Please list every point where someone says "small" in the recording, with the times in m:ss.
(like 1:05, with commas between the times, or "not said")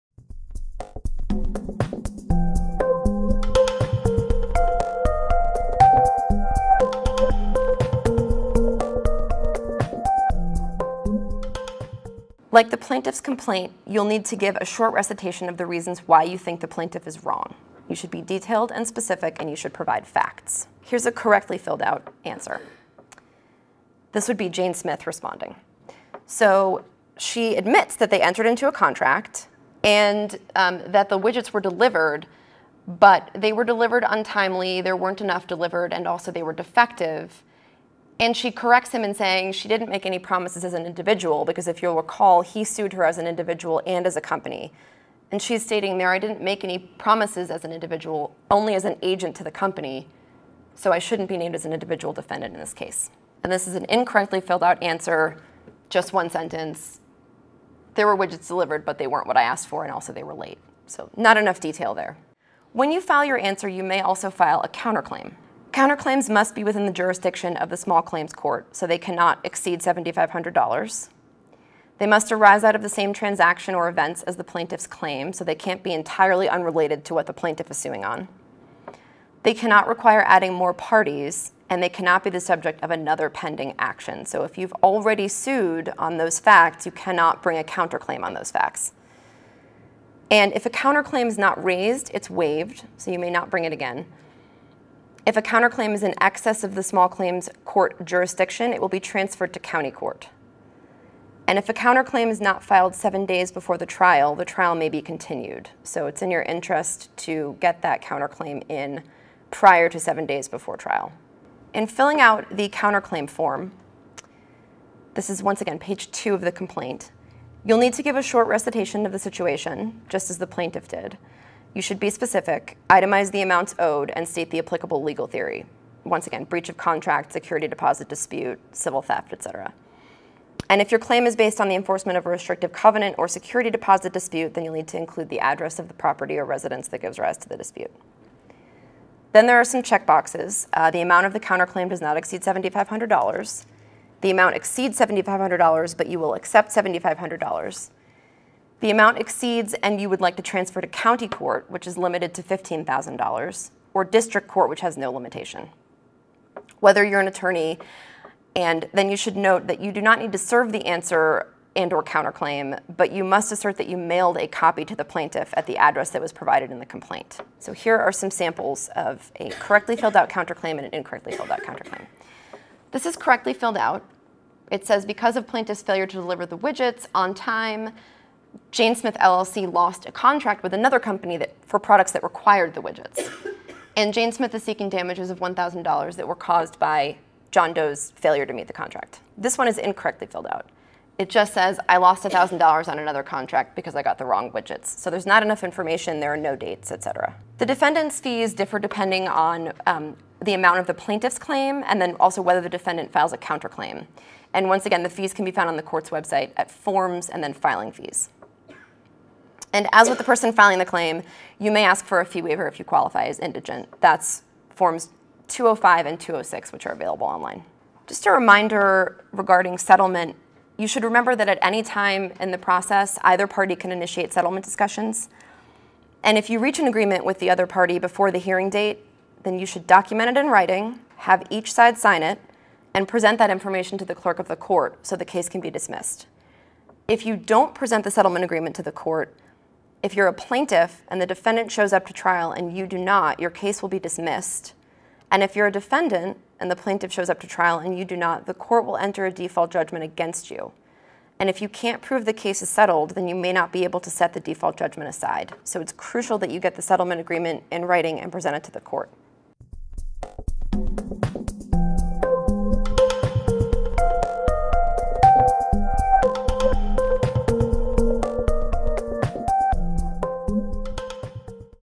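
1:07, 1:36.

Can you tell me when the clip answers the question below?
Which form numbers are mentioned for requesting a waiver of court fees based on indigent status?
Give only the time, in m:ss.
3:35.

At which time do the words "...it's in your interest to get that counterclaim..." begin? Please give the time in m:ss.
1:46.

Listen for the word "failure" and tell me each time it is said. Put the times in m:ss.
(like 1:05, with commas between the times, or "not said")
2:55, 3:08.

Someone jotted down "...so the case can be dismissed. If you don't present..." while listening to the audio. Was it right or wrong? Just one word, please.
right.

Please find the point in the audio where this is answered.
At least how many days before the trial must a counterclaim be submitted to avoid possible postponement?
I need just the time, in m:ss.
1:42.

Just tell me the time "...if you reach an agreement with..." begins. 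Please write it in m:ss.
3:46.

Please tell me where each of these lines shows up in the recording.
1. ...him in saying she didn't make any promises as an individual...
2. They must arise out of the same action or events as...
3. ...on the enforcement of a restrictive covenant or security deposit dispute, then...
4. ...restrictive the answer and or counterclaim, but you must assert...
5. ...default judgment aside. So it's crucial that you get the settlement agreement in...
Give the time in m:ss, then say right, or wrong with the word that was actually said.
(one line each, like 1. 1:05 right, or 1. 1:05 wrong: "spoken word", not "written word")
1. 0:38 right
2. 1:11 wrong: "transaction", not "action"
3. 2:11 right
4. 2:40 wrong: "serve", not "restrictive"
5. 4:14 right.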